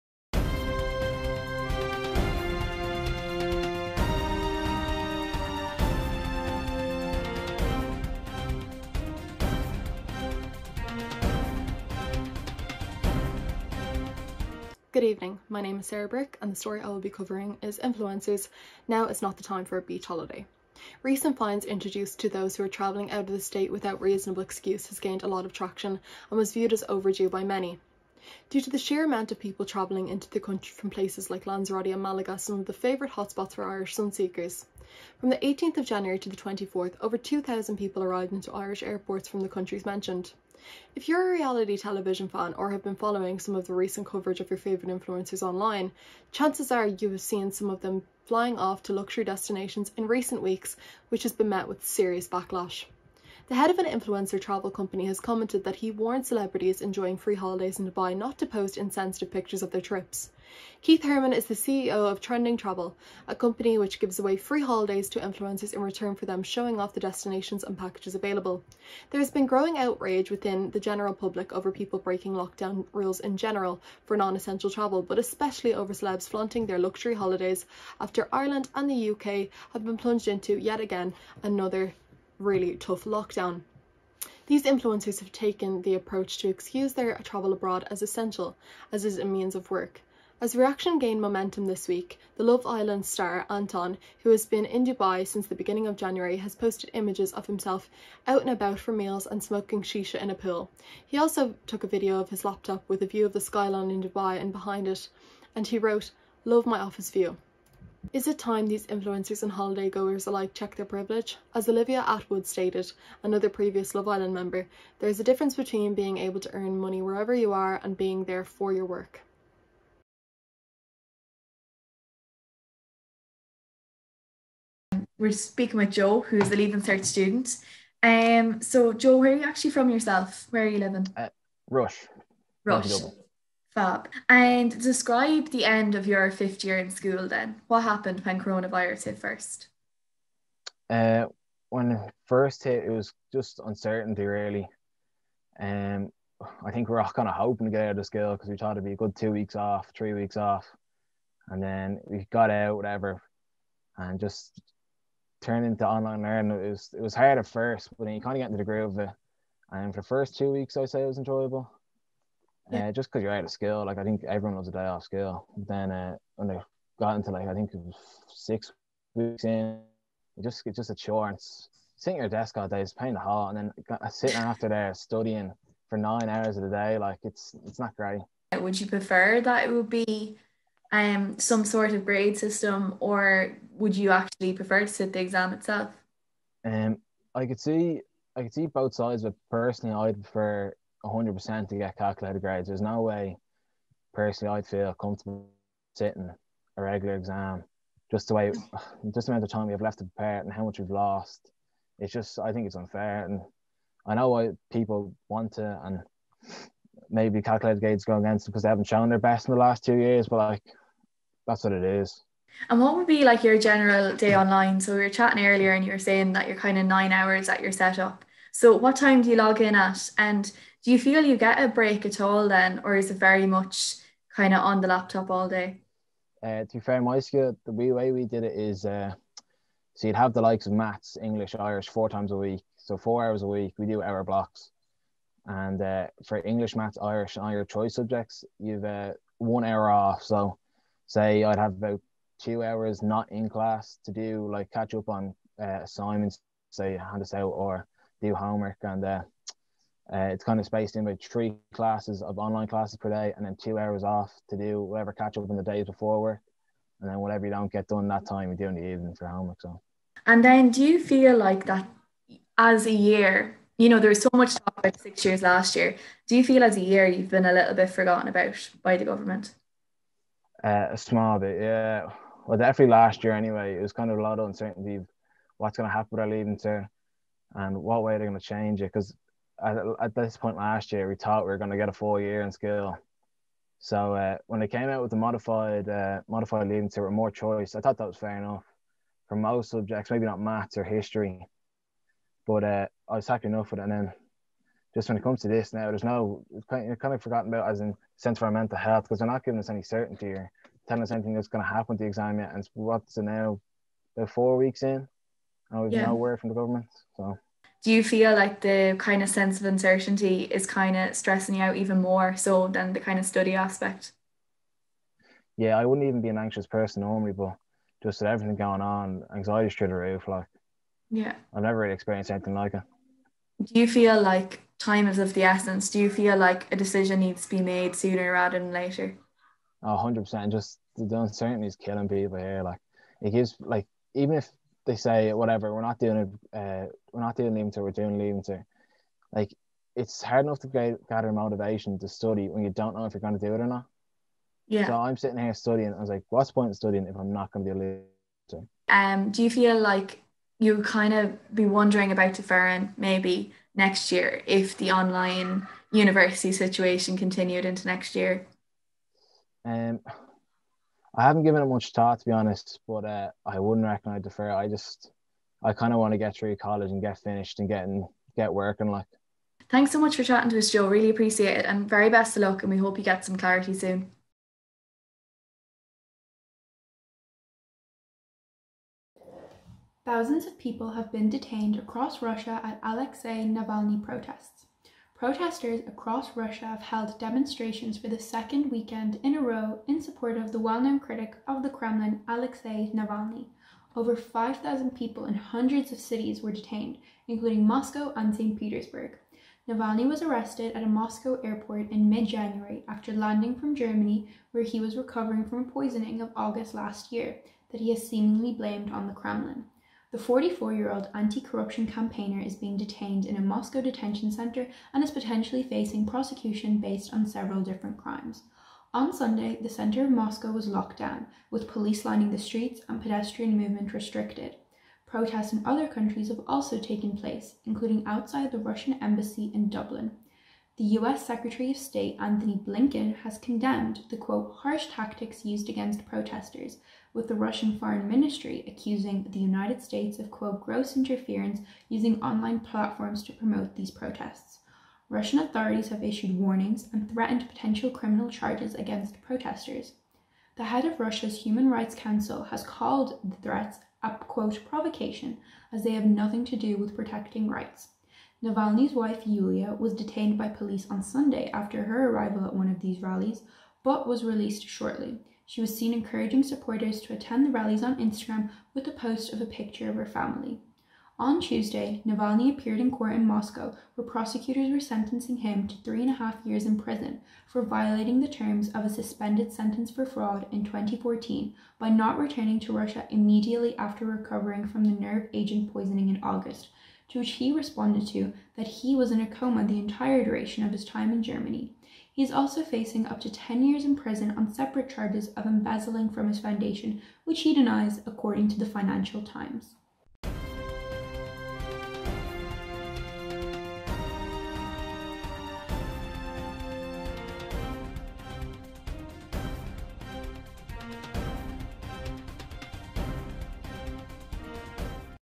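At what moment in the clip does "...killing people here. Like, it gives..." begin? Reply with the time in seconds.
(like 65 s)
331 s.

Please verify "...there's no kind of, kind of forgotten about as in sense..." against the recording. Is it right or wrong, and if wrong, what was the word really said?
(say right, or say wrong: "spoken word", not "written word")
right.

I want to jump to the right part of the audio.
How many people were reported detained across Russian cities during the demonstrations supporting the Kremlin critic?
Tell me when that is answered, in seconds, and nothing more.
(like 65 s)
393 s.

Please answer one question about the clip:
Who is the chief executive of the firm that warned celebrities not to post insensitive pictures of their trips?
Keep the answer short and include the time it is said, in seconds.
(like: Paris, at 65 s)
Keith Herman, at 60 s.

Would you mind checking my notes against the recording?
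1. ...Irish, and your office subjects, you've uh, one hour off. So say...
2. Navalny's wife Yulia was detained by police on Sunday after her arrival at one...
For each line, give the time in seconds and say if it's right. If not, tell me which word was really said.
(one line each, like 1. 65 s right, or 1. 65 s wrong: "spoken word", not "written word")
1. 237 s wrong: "choice", not "office"
2. 458 s right.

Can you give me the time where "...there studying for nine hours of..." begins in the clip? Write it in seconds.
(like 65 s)
174 s.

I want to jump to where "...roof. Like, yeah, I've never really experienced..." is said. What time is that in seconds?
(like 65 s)
319 s.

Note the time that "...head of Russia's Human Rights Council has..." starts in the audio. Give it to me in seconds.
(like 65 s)
450 s.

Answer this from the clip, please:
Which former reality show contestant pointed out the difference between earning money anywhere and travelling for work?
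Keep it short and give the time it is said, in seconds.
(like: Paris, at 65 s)
Olivia Attwood, at 111 s.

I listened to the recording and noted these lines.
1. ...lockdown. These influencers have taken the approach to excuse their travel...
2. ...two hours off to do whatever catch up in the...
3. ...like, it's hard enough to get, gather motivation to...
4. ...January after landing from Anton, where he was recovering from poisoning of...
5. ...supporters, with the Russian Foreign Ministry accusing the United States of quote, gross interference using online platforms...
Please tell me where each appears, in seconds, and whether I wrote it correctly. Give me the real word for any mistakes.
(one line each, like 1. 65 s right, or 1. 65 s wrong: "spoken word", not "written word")
1. 83 s right
2. 253 s right
3. 339 s right
4. 402 s wrong: "Germany", not "Anton"
5. 436 s wrong: "protesters", not "supporters".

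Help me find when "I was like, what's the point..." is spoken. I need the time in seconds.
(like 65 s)
345 s.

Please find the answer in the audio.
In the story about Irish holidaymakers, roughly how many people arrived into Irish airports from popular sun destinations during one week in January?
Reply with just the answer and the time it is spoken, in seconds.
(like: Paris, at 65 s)
2,000, at 37 s.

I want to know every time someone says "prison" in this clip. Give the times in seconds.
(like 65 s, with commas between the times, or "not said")
476 s, 493 s.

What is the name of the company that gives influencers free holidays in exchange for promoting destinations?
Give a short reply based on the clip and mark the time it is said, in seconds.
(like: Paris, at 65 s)
Trending Travel, at 62 s.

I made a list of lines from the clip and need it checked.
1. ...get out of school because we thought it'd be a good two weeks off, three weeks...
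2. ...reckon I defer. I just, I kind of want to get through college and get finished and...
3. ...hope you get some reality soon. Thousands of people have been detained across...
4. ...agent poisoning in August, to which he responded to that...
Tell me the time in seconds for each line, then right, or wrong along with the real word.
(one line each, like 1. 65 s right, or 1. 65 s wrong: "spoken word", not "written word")
1. 147 s right
2. 363 s right
3. 372 s wrong: "clarity", not "reality"
4. 485 s right.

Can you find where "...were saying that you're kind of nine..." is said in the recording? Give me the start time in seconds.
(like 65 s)
215 s.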